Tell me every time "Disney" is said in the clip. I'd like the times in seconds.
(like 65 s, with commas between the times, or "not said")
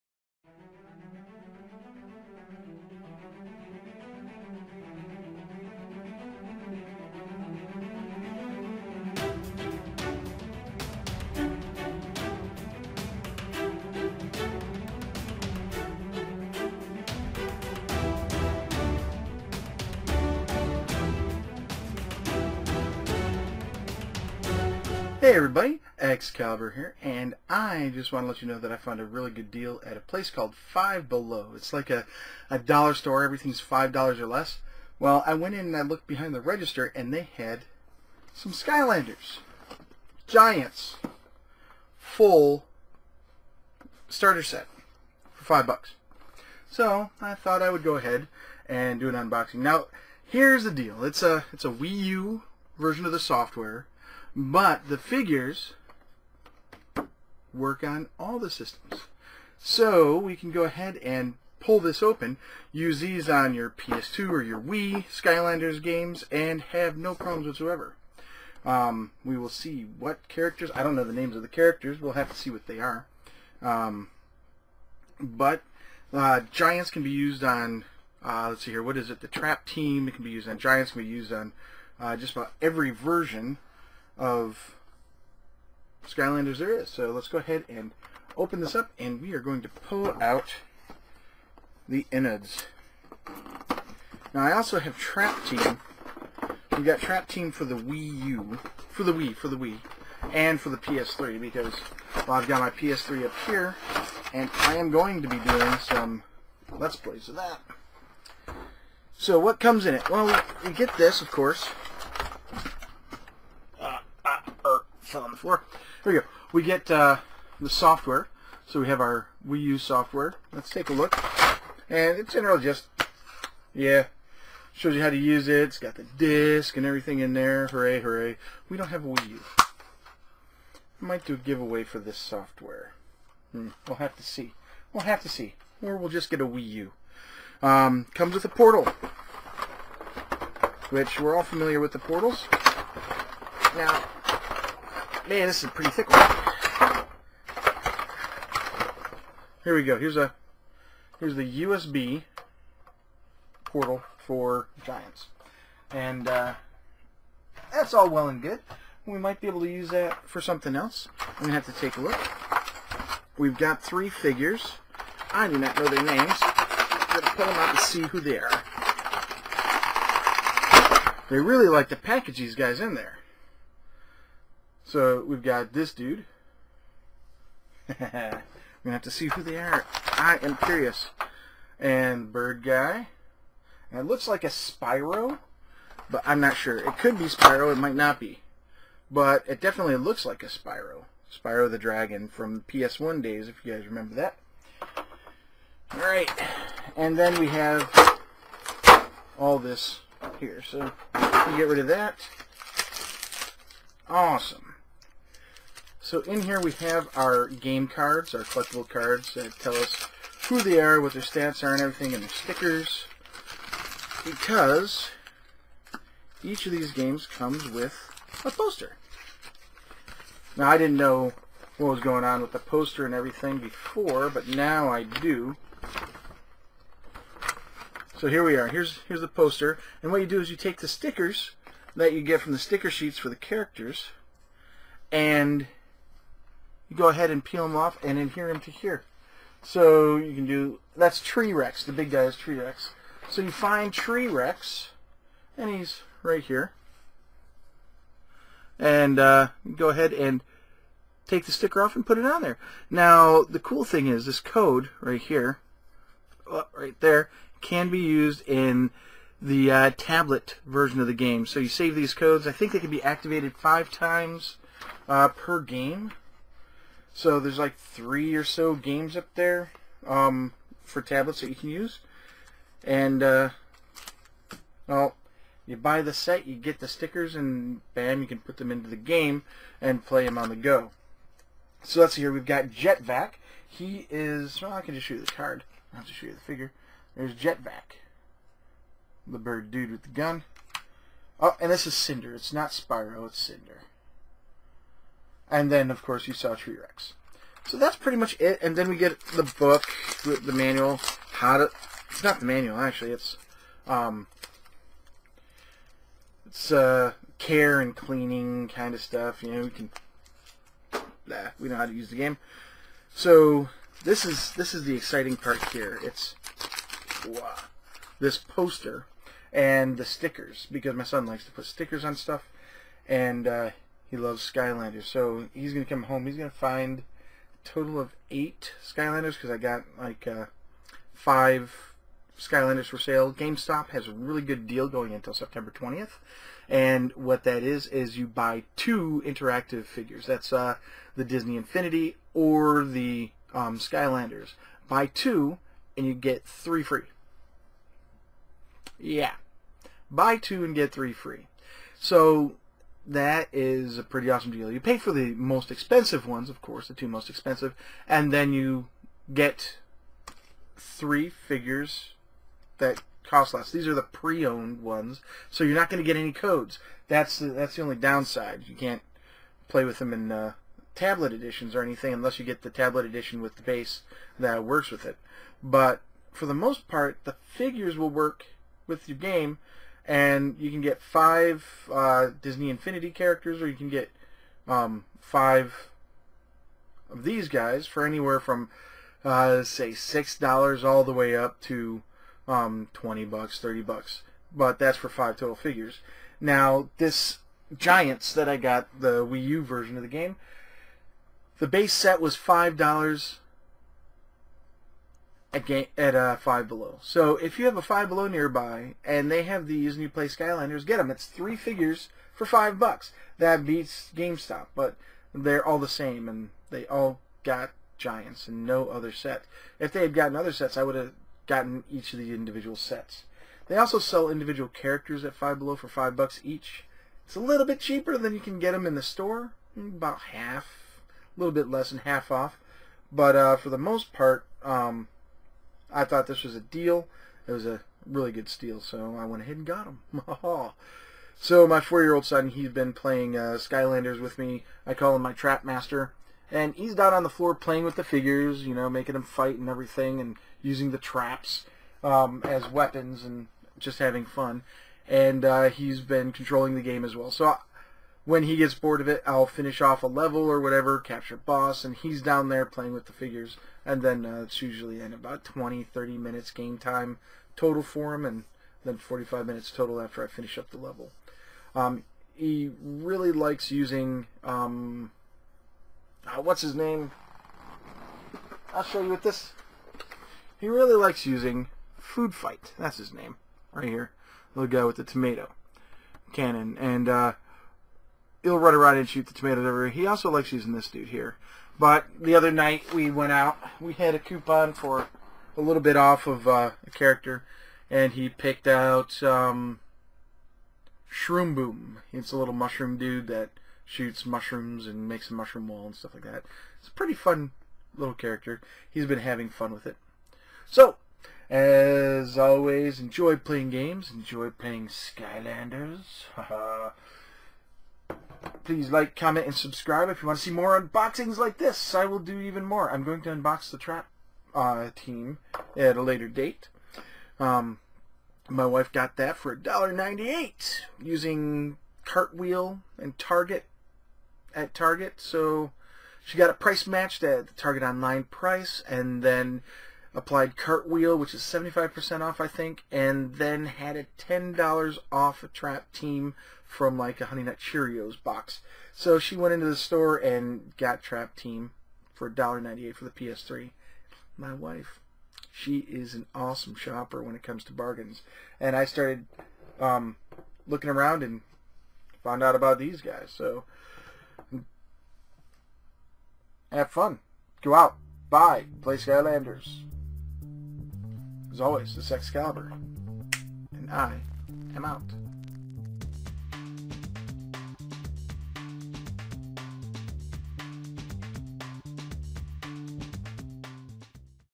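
341 s, 382 s.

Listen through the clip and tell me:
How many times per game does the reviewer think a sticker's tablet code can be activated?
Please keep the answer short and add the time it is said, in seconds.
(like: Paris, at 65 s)
5, at 263 s.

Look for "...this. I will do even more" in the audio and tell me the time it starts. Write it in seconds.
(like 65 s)
521 s.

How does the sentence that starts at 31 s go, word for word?
It's like a, a dollar store, everything's five dollars or less.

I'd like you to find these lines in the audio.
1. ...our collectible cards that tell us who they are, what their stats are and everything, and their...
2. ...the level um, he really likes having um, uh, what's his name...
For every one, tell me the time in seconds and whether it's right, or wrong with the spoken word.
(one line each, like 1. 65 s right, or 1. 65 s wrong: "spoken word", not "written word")
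1. 208 s right
2. 470 s wrong: "using", not "having".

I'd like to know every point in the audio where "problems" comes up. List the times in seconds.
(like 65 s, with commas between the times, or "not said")
67 s.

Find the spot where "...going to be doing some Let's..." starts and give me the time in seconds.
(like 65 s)
104 s.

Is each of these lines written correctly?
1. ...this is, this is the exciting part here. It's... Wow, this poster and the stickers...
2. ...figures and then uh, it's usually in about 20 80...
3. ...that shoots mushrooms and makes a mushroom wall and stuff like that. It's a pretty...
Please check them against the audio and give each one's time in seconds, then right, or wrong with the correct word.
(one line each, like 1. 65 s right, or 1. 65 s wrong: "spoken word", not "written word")
1. 314 s right
2. 463 s wrong: "30", not "80"
3. 503 s right.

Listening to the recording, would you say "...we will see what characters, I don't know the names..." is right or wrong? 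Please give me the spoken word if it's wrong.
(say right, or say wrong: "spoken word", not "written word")
right.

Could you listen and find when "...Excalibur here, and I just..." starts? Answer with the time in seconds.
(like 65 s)
25 s.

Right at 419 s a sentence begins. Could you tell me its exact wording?
If they had gotten other sets, I would have gotten each of the individual sets.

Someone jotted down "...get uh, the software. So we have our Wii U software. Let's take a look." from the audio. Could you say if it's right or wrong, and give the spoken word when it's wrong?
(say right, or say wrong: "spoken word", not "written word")
right.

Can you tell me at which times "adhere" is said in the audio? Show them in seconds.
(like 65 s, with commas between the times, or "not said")
238 s.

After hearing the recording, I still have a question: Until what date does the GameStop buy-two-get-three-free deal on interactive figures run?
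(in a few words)
September 20th.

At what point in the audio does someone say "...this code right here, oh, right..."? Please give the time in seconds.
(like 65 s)
254 s.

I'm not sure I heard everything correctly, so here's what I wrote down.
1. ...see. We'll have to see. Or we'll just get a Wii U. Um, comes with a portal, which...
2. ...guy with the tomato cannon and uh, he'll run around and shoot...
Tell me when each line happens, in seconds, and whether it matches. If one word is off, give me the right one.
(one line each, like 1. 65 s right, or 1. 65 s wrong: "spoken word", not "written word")
1. 134 s right
2. 484 s right.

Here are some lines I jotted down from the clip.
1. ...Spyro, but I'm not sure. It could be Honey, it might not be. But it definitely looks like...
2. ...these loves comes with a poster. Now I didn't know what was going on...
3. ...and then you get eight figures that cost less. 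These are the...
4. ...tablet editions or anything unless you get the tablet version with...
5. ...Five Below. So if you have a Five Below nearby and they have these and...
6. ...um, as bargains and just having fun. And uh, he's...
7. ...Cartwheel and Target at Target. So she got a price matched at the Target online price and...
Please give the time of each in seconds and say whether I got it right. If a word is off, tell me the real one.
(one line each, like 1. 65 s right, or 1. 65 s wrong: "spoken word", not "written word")
1. 184 s wrong: "Spyro", not "Honey"
2. 216 s wrong: "games", not "loves"
3. 358 s wrong: "three", not "eight"
4. 370 s wrong: "edition", not "version"
5. 406 s right
6. 452 s wrong: "weapons", not "bargains"
7. 532 s right.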